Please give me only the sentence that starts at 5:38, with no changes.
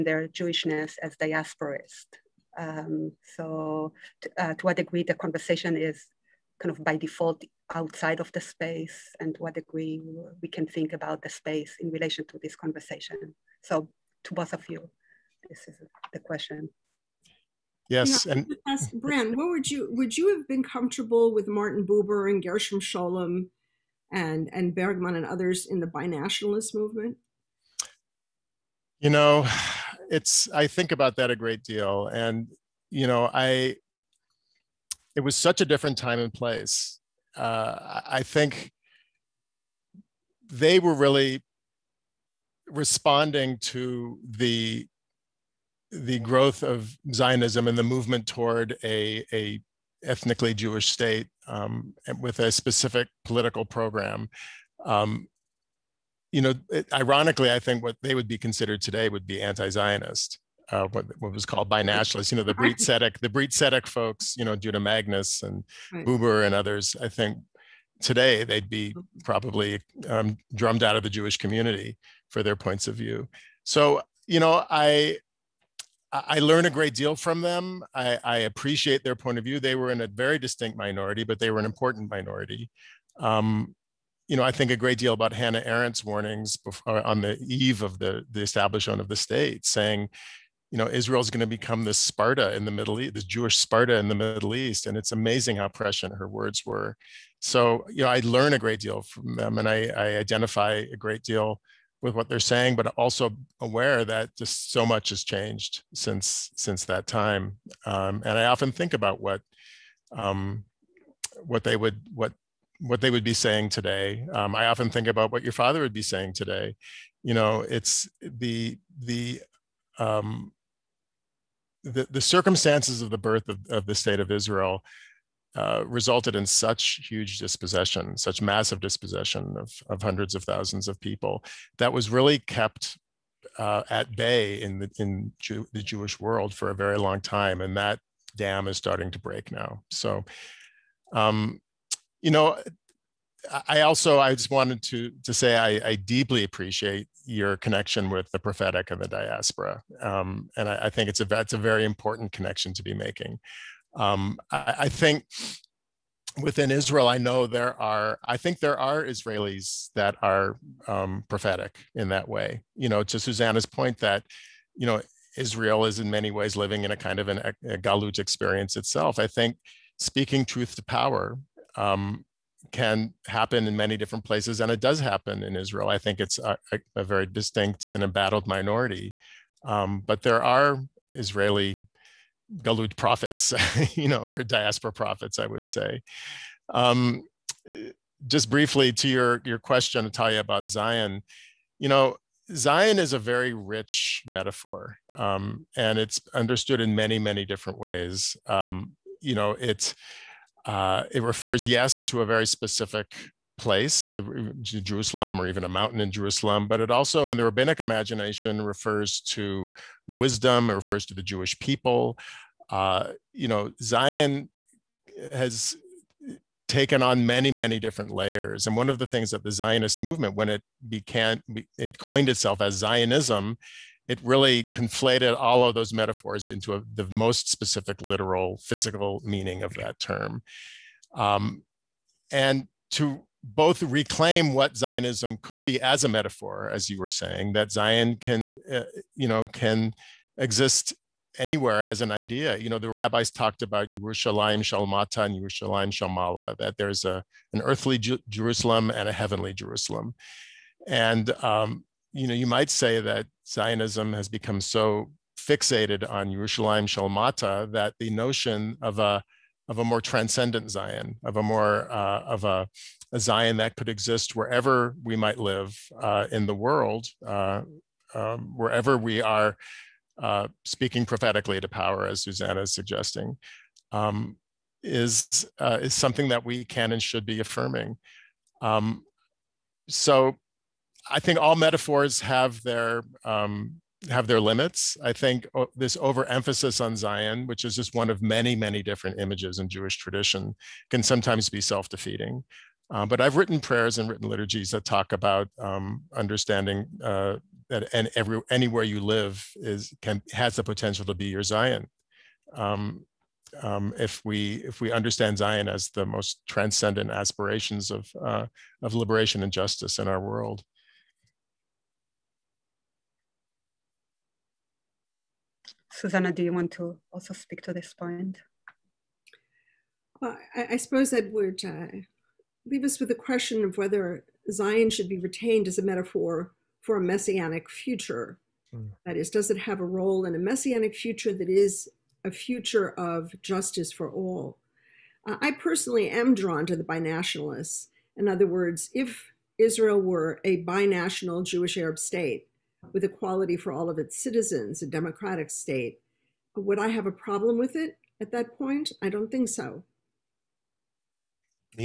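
In other words, if Israel were a binational Jewish Arab state, with equality for all of its citizens, a democratic state.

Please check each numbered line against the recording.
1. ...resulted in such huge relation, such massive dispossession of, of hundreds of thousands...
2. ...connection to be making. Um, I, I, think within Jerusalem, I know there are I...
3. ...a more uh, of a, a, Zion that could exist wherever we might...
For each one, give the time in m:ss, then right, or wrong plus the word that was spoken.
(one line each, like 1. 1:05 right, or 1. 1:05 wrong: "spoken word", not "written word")
1. 2:05 wrong: "dispossession", not "relation"
2. 2:32 wrong: "Israel", not "Jerusalem"
3. 4:21 right.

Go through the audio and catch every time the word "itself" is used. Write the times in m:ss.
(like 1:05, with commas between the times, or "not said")
2:48, 3:42.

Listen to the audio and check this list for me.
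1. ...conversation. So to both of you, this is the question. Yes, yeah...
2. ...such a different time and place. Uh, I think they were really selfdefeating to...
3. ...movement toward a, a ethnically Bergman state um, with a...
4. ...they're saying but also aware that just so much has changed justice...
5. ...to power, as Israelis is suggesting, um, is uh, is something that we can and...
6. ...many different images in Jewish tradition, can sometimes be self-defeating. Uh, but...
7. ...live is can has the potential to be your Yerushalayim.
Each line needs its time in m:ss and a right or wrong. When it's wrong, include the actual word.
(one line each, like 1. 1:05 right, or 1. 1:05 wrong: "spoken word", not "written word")
1. 0:12 right
2. 0:35 wrong: "responding", not "selfdefeating"
3. 0:47 wrong: "Jewish", not "Bergman"
4. 1:42 wrong: "since", not "justice"
5. 4:31 wrong: "Susannah", not "Israelis"
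6. 4:48 right
7. 4:59 wrong: "Zion", not "Yerushalayim".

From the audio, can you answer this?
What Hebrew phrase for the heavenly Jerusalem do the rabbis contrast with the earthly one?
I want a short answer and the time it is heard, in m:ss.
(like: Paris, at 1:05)
Yerushalayim shel Maalah, at 4:05.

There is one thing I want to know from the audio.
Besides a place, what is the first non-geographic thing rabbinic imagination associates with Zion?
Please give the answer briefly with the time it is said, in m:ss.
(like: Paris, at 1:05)
Wisdom, at 3:30.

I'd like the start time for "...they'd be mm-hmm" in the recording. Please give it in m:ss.
1:08.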